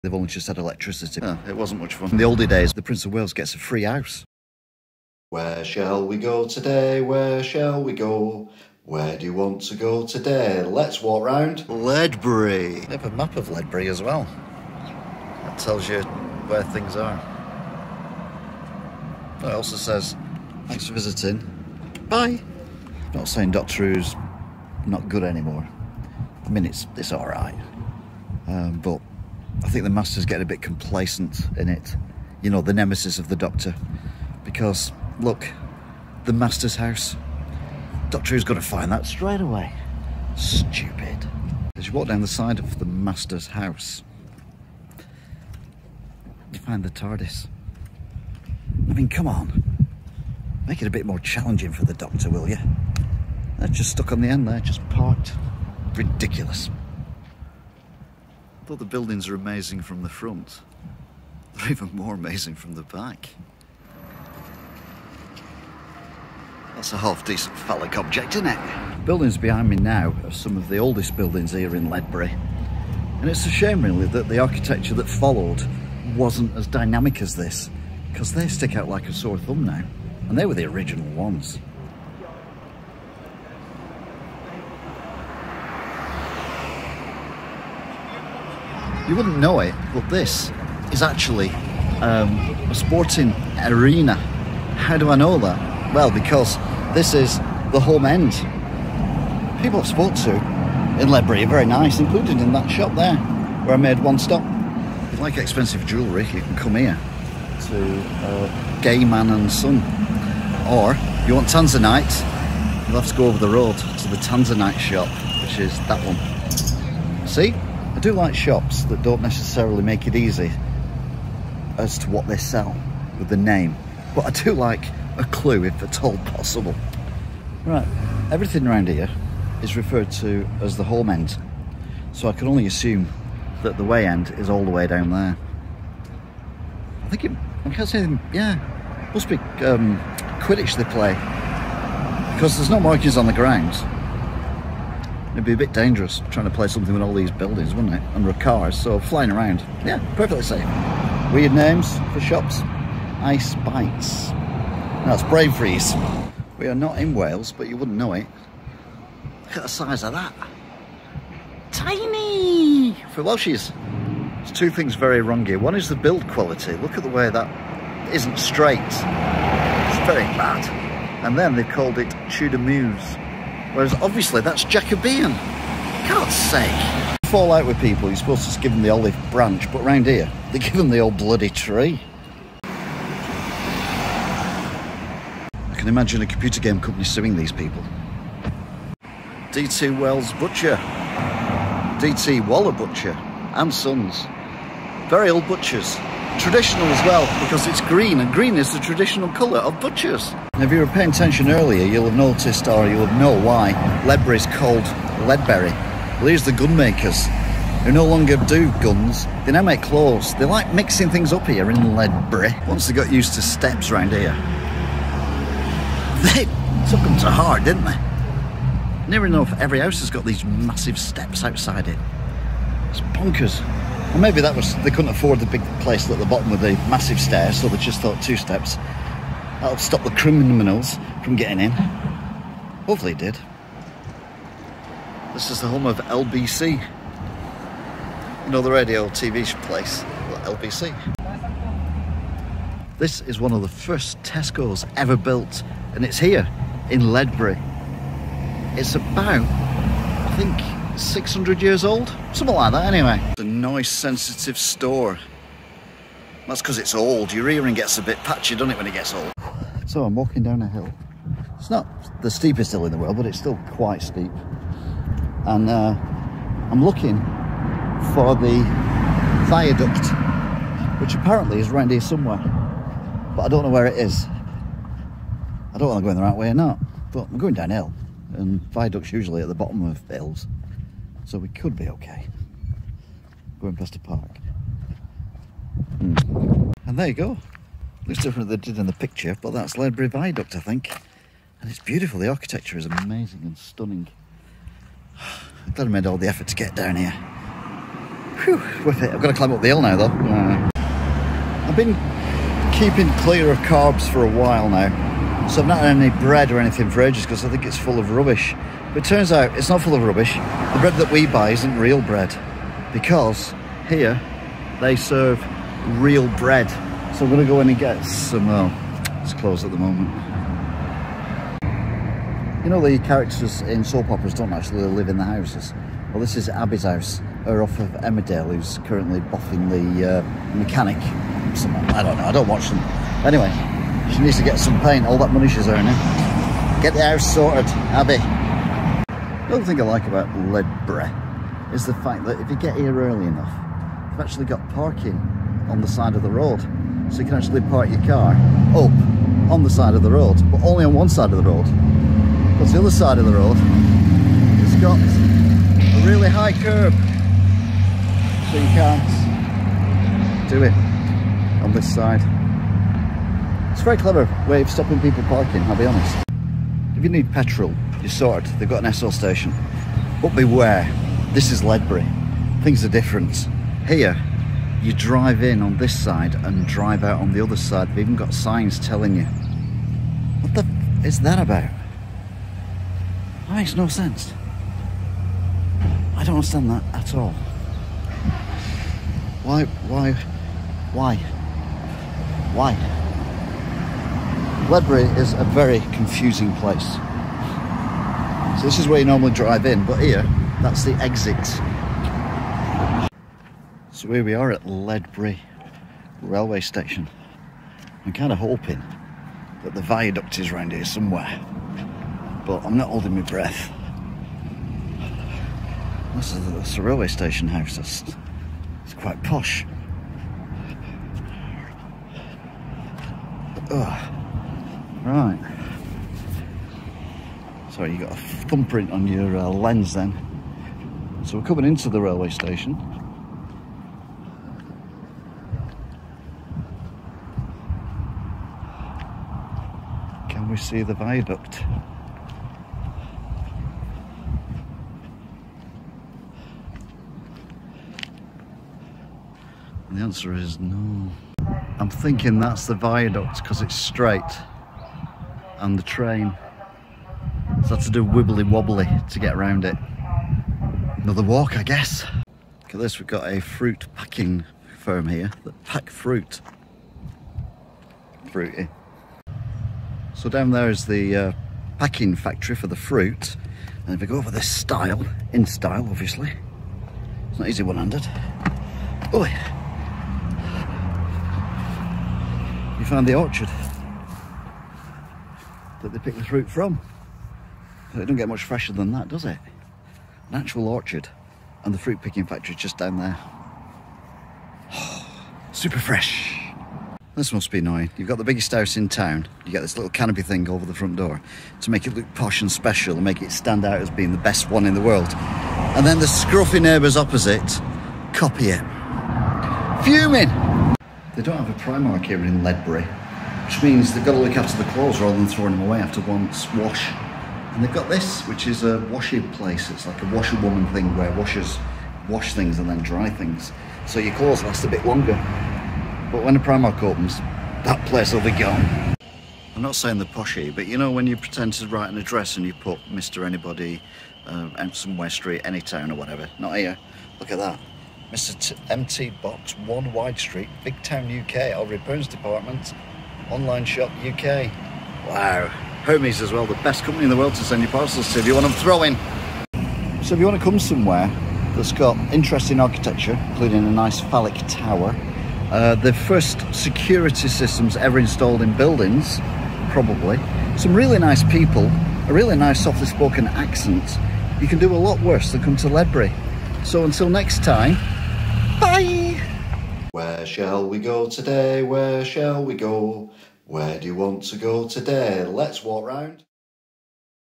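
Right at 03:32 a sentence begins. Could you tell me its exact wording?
Once they got used to steps round here, they took them to heart, didn't they?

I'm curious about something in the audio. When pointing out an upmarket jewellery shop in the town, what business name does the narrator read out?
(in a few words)
Gay Man and Son.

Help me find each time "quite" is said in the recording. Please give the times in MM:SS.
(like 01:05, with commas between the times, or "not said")
04:23, 06:58.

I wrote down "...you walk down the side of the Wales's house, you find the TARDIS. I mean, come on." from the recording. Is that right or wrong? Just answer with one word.
wrong.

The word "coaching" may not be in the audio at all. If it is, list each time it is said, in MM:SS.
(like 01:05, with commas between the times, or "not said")
not said.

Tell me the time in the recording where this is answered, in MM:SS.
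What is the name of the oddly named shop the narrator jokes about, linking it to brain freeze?
02:33.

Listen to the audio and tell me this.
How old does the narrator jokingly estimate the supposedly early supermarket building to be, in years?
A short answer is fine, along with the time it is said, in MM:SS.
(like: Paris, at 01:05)
600, at 04:10.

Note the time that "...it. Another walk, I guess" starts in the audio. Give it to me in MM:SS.
07:39.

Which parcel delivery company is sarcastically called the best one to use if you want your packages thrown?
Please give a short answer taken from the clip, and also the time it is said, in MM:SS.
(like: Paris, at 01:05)
Hermes, at 09:05.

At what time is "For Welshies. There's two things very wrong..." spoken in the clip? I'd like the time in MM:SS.
02:43.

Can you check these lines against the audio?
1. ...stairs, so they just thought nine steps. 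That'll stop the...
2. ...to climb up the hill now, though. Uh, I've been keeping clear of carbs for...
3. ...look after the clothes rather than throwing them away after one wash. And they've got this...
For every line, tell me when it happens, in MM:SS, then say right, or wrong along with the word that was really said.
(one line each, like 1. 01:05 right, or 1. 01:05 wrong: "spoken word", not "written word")
1. 03:47 wrong: "two", not "nine"
2. 04:59 right
3. 08:34 right.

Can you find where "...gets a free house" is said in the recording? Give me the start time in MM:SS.
00:03.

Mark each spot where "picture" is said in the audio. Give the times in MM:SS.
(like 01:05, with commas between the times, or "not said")
04:48.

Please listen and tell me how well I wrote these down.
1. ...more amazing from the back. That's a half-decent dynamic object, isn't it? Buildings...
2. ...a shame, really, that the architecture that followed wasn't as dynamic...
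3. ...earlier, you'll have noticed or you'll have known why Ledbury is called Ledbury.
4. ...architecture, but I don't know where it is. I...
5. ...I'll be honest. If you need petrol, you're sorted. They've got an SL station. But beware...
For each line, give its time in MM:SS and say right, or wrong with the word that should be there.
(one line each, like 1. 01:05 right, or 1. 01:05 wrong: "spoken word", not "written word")
1. 01:01 wrong: "phallic", not "dynamic"
2. 01:13 right
3. 03:21 right
4. 04:32 wrong: "somewhere", not "architecture"
5. 06:05 right.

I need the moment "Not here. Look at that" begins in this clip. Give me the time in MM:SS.
08:56.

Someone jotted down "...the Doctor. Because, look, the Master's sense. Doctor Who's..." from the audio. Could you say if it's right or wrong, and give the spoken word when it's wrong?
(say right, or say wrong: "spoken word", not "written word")
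wrong: "house", not "sense".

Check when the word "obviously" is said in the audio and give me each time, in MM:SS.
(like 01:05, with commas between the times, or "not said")
02:54, 07:55.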